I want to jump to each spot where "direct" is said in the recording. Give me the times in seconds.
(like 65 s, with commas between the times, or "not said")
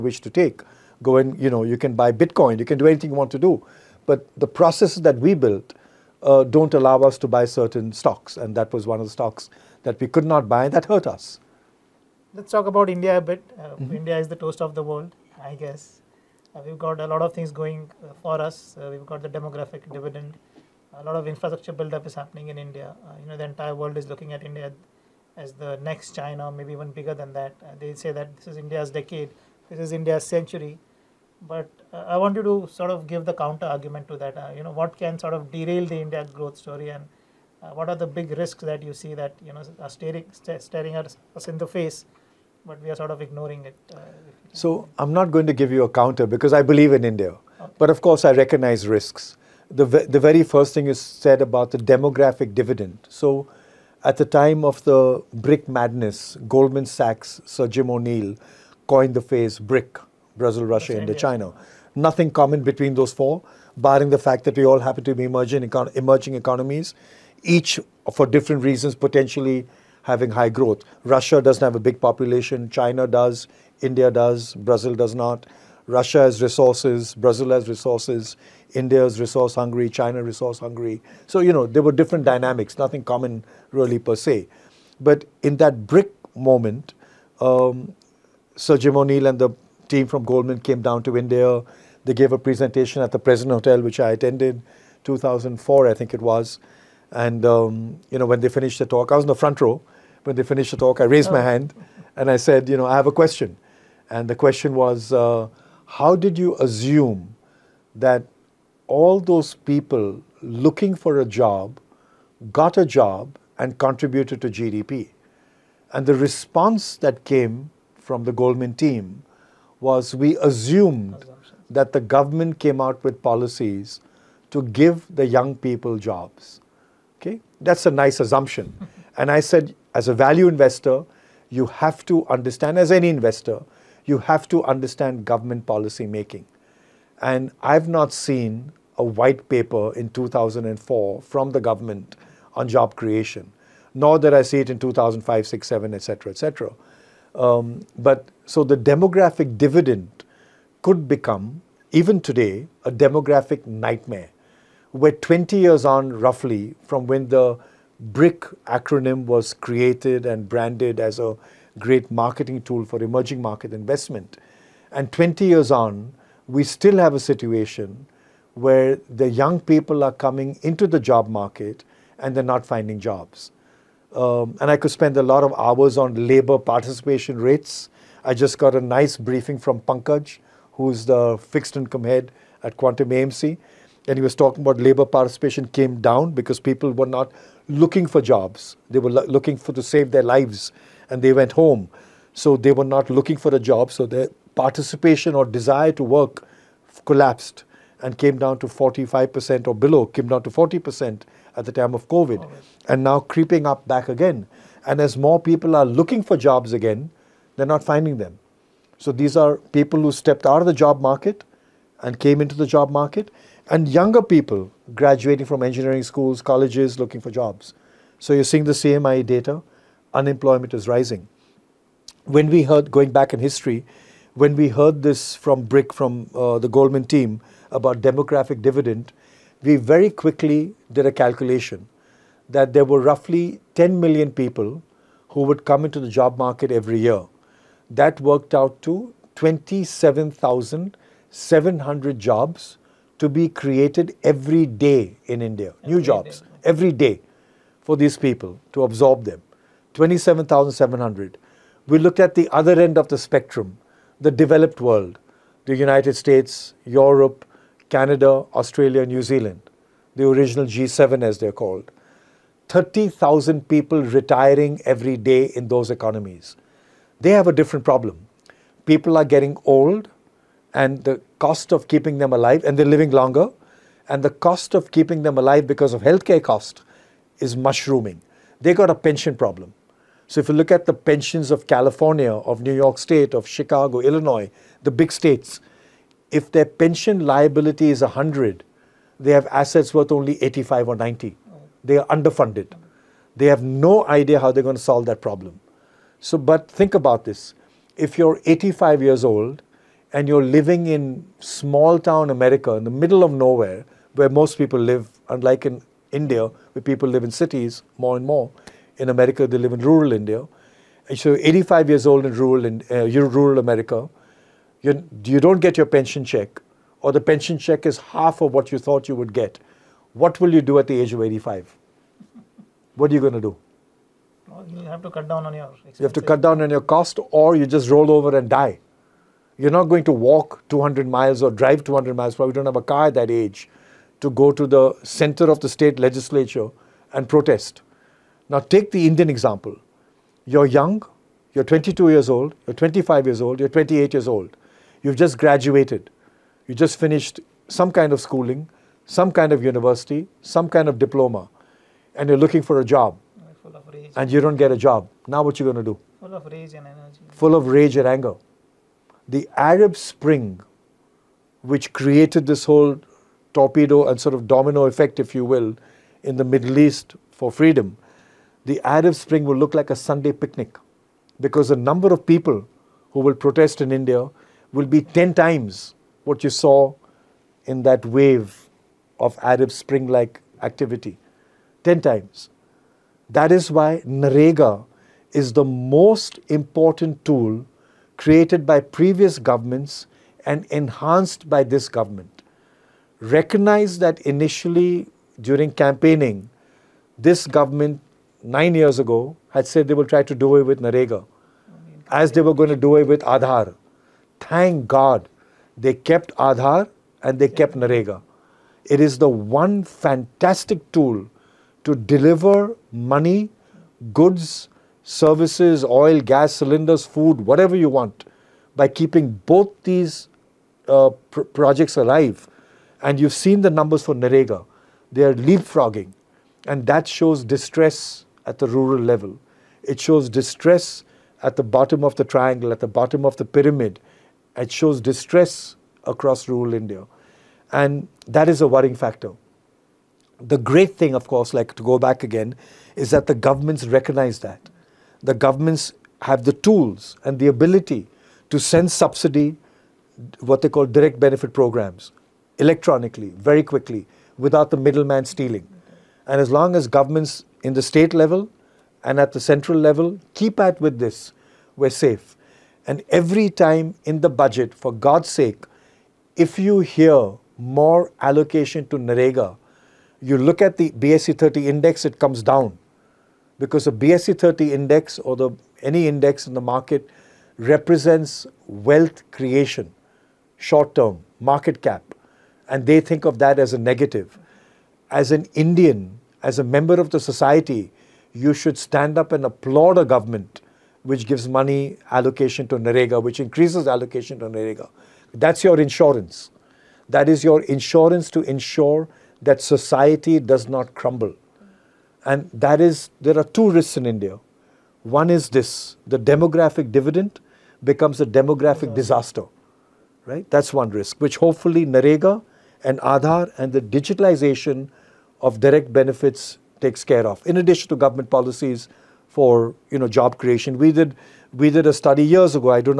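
450 s, 515 s.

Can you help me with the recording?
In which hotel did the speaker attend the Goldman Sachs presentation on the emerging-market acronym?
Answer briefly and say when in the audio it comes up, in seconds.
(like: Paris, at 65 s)
President Hotel, at 93 s.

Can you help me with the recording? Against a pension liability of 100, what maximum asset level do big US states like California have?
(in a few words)
90.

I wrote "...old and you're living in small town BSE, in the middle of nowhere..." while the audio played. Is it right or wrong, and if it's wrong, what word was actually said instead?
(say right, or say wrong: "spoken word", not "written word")
wrong: "America", not "BSE".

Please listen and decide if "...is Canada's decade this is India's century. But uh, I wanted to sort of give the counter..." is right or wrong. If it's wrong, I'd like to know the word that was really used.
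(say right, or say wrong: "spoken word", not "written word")
wrong: "India", not "Canada".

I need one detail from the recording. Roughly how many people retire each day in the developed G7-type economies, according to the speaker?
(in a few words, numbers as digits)
30,000.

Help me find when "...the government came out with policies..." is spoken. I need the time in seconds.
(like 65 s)
121 s.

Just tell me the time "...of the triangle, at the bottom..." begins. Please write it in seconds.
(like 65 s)
432 s.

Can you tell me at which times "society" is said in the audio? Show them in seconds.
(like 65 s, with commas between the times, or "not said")
487 s, 499 s.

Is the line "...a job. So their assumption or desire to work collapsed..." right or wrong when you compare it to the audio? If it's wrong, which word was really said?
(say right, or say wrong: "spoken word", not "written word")
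wrong: "participation", not "assumption".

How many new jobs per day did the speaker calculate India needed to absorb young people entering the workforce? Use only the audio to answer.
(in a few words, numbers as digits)
27,700.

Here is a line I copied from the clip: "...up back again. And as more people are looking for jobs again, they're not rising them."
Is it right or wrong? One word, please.
wrong.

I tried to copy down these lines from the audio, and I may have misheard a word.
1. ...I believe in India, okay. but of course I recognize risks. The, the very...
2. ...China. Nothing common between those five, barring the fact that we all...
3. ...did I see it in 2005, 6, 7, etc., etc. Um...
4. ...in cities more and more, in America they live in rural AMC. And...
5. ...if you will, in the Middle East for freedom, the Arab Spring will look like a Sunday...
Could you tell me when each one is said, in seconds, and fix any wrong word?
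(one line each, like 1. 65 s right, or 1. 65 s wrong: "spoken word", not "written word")
1. 46 s right
2. 61 s wrong: "four", not "five"
3. 144 s right
4. 307 s wrong: "India", not "AMC"
5. 365 s right.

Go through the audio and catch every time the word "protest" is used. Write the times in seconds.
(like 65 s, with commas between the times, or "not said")
337 s, 373 s.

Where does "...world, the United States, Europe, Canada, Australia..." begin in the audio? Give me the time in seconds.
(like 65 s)
254 s.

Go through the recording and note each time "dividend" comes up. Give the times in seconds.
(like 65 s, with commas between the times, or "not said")
19 s, 52 s, 149 s, 228 s, 506 s.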